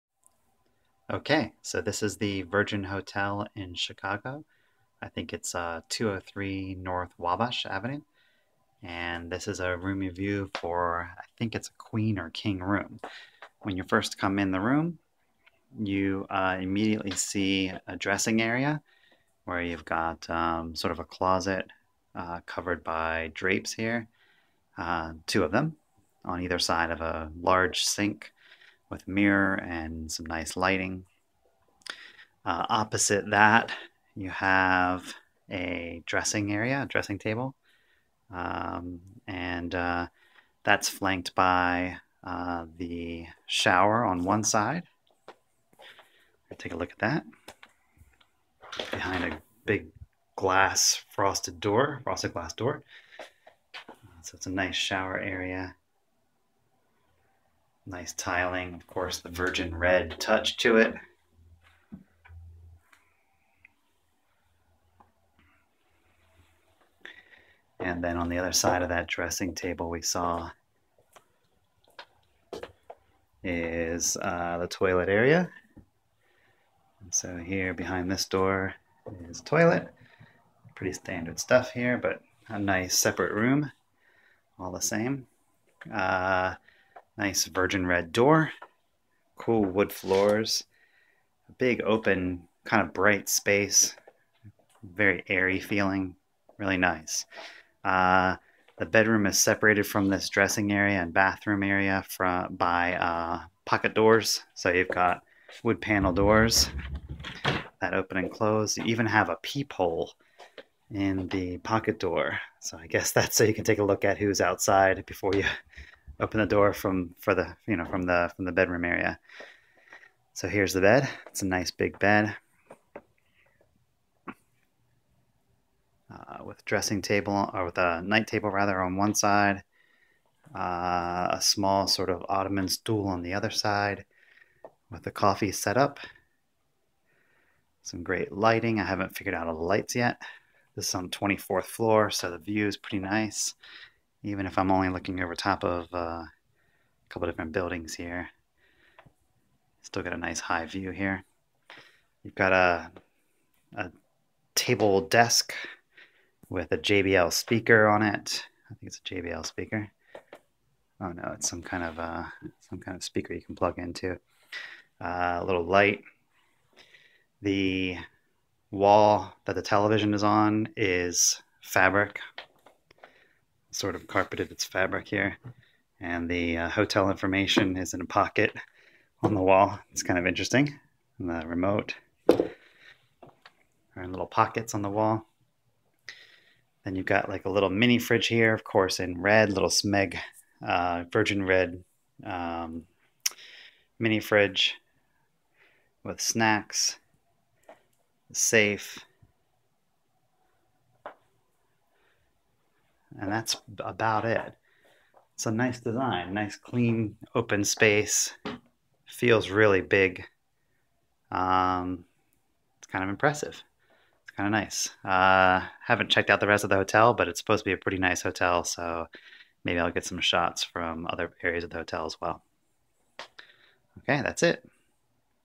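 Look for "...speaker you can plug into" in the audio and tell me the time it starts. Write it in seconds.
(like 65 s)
163 s.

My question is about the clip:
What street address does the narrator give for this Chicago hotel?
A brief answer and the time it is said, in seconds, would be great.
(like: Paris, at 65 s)
203 North Wabash Avenue, at 5 s.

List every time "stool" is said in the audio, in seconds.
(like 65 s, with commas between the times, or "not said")
132 s.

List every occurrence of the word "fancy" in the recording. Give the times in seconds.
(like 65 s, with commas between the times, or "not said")
not said.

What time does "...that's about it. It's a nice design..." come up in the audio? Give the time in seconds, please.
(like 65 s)
203 s.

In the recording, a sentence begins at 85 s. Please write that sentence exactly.
Uh, Nice virgin red door, cool wood floors, a big open, kind of bright space, very airy feeling, really nice.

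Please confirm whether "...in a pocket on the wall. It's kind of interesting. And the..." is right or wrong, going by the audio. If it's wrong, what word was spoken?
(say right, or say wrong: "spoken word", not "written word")
right.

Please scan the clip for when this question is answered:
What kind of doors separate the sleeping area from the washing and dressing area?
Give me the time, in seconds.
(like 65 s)
103 s.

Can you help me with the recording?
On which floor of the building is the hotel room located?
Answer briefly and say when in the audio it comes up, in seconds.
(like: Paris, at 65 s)
24th floor, at 141 s.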